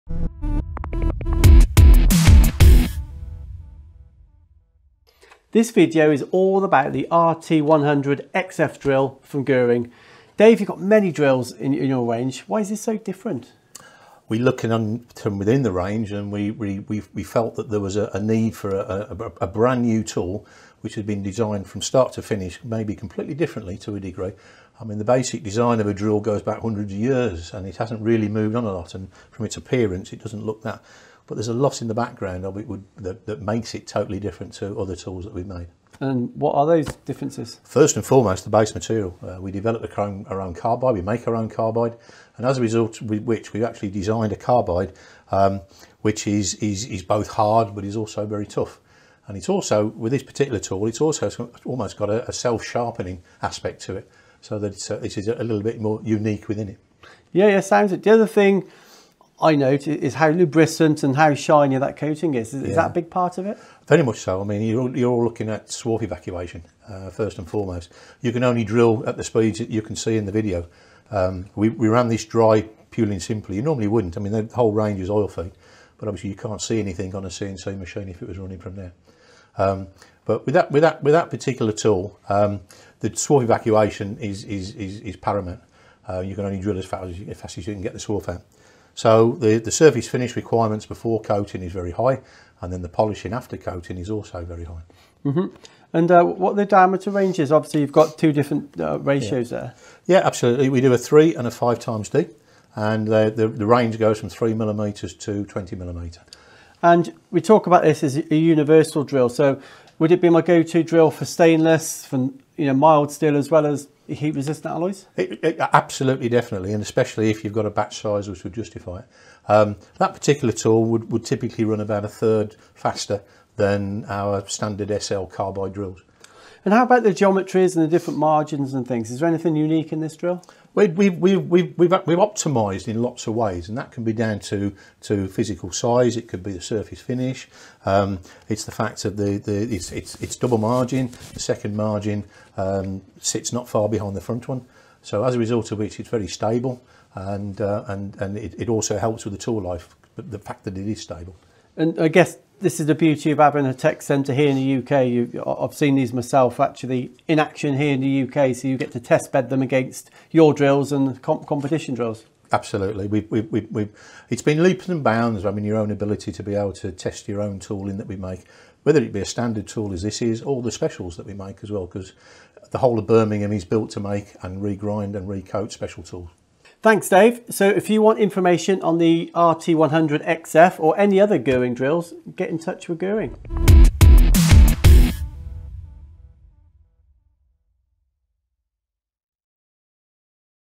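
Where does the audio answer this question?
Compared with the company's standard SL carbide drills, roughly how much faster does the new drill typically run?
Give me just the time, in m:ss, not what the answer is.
2:02.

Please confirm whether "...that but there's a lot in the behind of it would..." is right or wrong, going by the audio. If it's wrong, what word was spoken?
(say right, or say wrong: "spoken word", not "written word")
wrong: "background", not "behind".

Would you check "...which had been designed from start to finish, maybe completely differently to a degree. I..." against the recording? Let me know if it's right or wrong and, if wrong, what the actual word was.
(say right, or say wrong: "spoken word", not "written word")
right.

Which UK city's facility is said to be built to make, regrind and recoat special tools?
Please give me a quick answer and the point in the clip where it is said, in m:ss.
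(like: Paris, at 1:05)
Birmingham, at 2:53.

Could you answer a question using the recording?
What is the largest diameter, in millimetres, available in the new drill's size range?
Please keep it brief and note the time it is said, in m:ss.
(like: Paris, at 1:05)
20 millimetre, at 1:45.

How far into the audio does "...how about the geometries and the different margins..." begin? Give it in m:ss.
2:06.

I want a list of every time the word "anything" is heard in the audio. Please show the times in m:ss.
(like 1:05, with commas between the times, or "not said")
1:16, 2:09.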